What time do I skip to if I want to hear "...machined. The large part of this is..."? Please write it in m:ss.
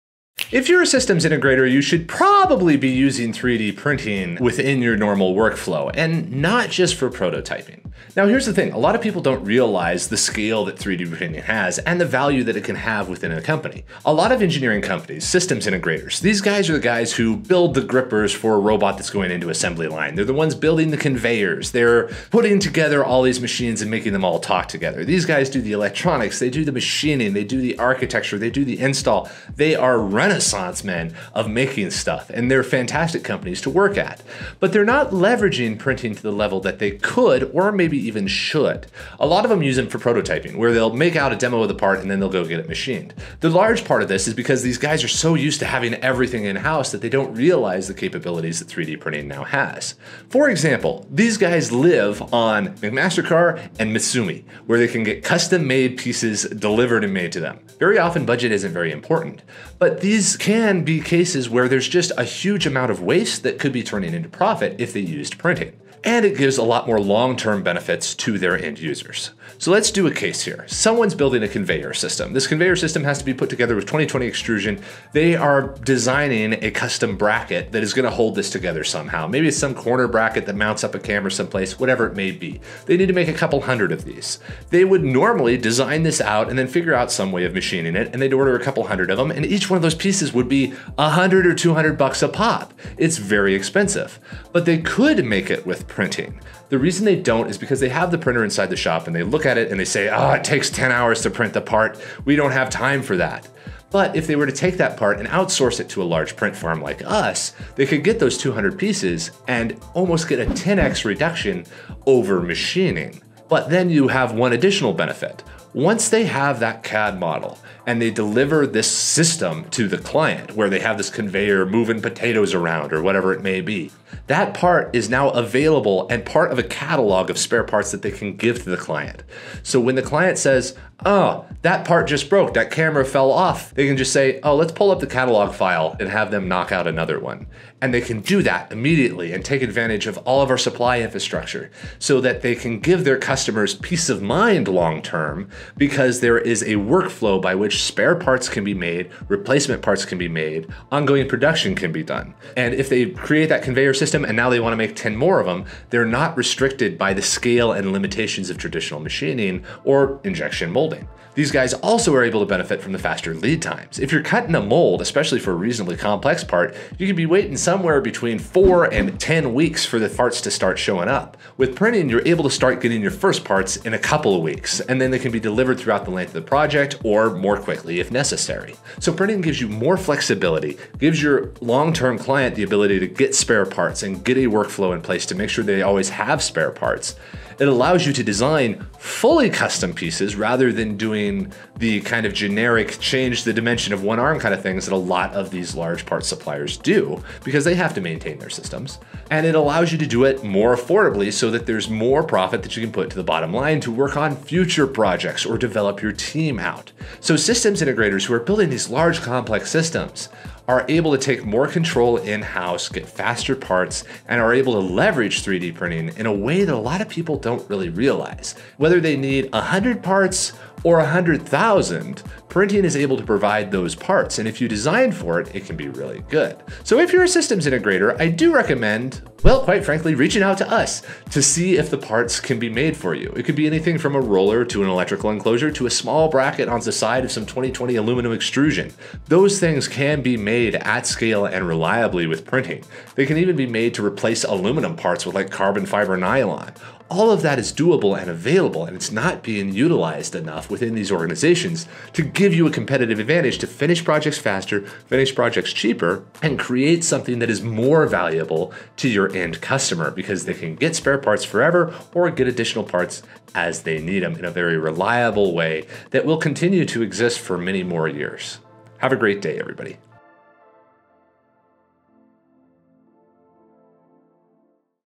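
0:42.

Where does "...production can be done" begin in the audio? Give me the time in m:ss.
2:31.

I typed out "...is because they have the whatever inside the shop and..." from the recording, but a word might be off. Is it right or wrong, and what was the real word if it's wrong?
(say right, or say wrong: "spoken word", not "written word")
wrong: "printer", not "whatever".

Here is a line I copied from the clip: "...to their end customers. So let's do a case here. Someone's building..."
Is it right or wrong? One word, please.
wrong.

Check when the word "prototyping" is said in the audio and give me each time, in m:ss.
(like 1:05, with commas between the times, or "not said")
0:07, 0:39.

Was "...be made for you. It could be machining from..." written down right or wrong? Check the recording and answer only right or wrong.
wrong.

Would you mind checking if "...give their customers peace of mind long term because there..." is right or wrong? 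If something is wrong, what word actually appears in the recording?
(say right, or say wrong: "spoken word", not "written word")
right.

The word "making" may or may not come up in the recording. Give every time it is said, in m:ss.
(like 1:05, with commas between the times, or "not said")
0:23, 0:31.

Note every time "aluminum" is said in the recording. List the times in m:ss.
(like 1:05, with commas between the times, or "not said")
3:57, 4:04.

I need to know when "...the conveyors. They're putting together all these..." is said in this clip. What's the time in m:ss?
0:20.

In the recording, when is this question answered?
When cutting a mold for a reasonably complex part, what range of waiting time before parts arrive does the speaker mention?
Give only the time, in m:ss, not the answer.
2:48.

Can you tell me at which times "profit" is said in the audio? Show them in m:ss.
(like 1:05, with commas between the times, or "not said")
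1:04, 3:22.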